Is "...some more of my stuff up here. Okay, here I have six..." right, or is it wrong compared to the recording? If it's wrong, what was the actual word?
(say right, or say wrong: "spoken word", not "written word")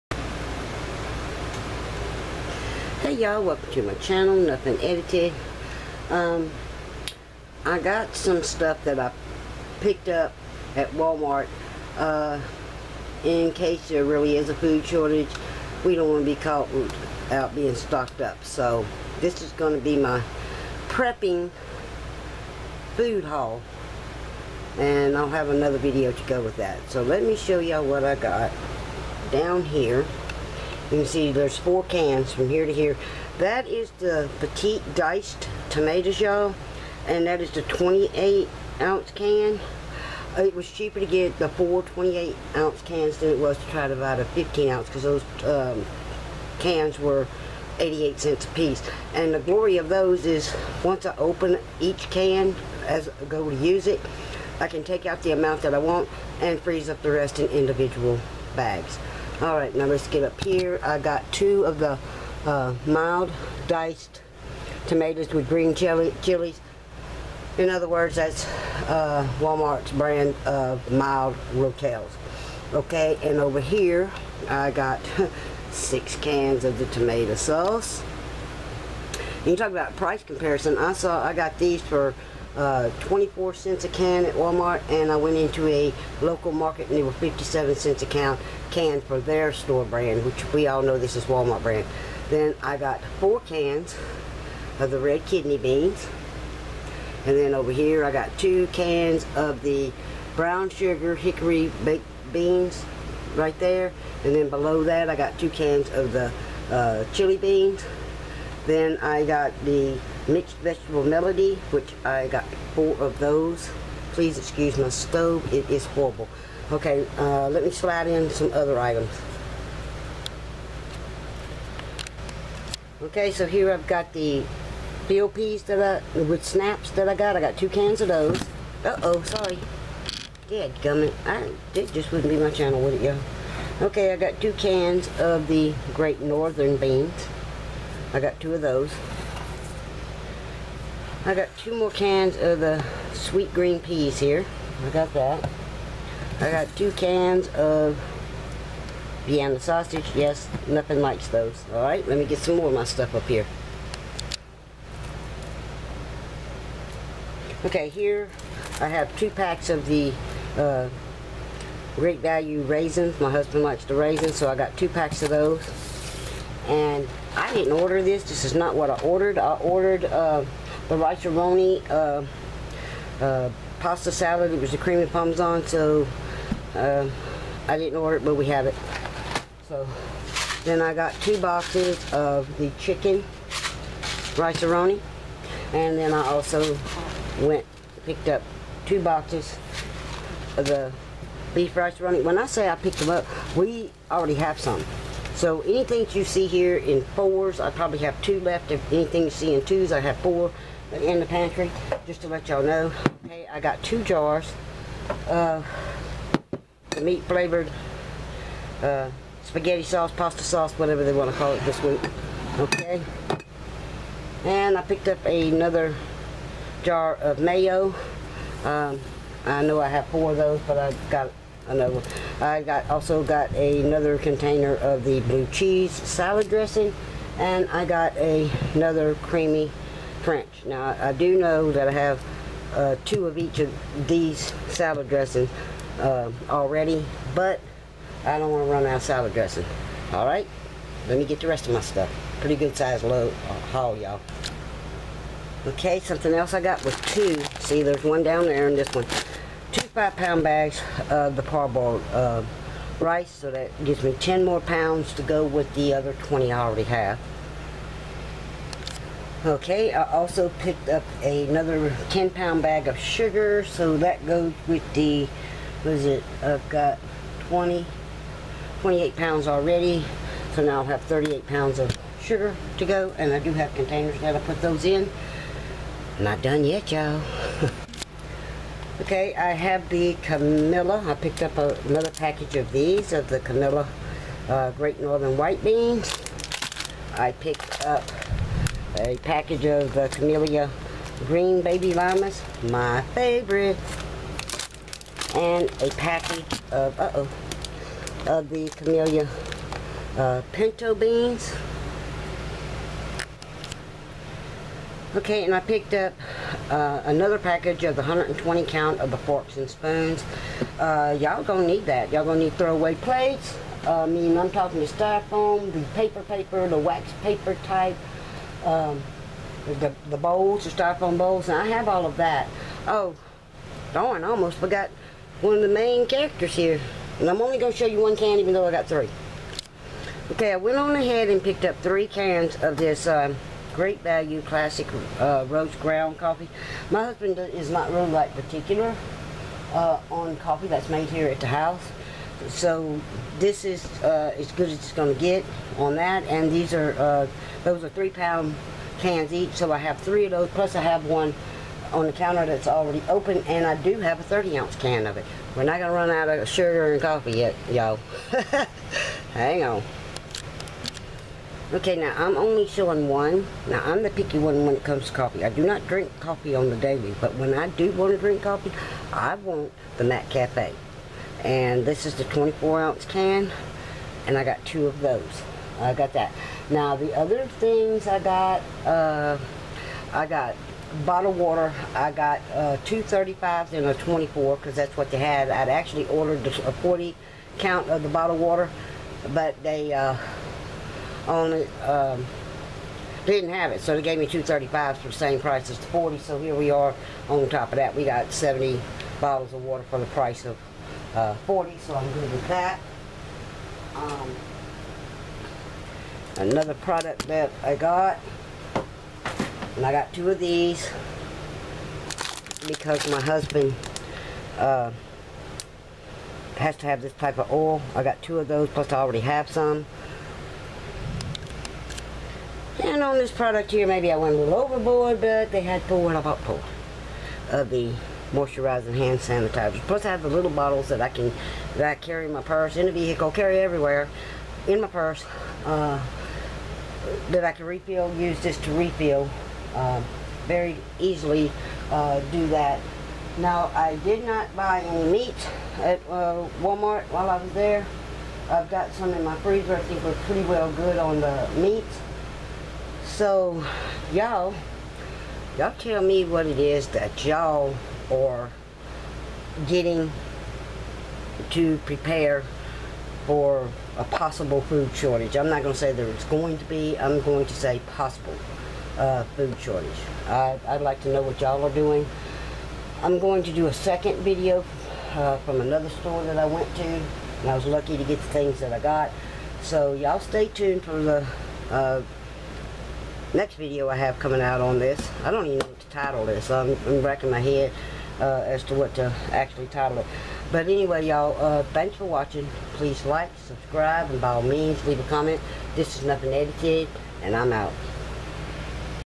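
wrong: "two", not "six".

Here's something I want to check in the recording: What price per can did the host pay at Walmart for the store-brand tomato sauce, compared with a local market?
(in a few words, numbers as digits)
24 cents.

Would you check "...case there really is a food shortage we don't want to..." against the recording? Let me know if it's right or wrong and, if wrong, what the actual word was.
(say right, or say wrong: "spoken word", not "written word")
right.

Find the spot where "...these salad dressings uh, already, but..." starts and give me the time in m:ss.
3:54.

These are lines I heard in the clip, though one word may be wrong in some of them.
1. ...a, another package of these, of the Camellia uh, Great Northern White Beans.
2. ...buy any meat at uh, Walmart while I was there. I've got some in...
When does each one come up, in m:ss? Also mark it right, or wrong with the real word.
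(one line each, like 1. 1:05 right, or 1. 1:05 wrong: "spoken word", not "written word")
1. 4:41 right
2. 7:24 right.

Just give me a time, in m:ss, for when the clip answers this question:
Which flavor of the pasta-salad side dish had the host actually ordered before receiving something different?
2:54.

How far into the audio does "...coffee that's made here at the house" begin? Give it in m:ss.
5:40.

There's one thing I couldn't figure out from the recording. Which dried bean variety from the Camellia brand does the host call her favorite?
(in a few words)
Green Baby Limas.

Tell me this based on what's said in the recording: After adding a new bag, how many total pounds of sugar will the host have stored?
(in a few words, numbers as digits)
38 pounds.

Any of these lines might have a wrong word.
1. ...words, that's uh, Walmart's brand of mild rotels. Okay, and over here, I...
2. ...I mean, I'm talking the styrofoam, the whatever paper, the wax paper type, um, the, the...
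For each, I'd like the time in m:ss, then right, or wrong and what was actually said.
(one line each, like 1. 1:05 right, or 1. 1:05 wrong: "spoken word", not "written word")
1. 1:07 right
2. 5:14 wrong: "paper", not "whatever".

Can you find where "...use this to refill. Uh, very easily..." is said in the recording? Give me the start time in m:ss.
7:18.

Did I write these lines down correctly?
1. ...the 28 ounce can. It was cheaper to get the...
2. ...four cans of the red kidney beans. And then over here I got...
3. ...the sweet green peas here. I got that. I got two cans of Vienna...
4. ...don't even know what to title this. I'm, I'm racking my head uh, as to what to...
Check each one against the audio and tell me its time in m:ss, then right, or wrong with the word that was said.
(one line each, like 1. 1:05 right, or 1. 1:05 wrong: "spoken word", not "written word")
1. 0:37 right
2. 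1:33 right
3. 2:22 right
4. 8:05 right.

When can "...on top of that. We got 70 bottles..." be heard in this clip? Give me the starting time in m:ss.
6:37.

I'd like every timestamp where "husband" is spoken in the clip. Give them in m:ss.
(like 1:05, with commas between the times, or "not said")
2:43, 5:37, 6:53.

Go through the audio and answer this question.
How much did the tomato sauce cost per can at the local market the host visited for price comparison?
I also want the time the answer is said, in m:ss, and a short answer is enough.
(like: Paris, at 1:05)
57 cents, at 1:27.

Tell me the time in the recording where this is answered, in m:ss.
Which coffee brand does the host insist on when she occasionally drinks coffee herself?
6:10.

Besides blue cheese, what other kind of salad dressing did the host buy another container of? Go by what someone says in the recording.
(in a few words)
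creamy French.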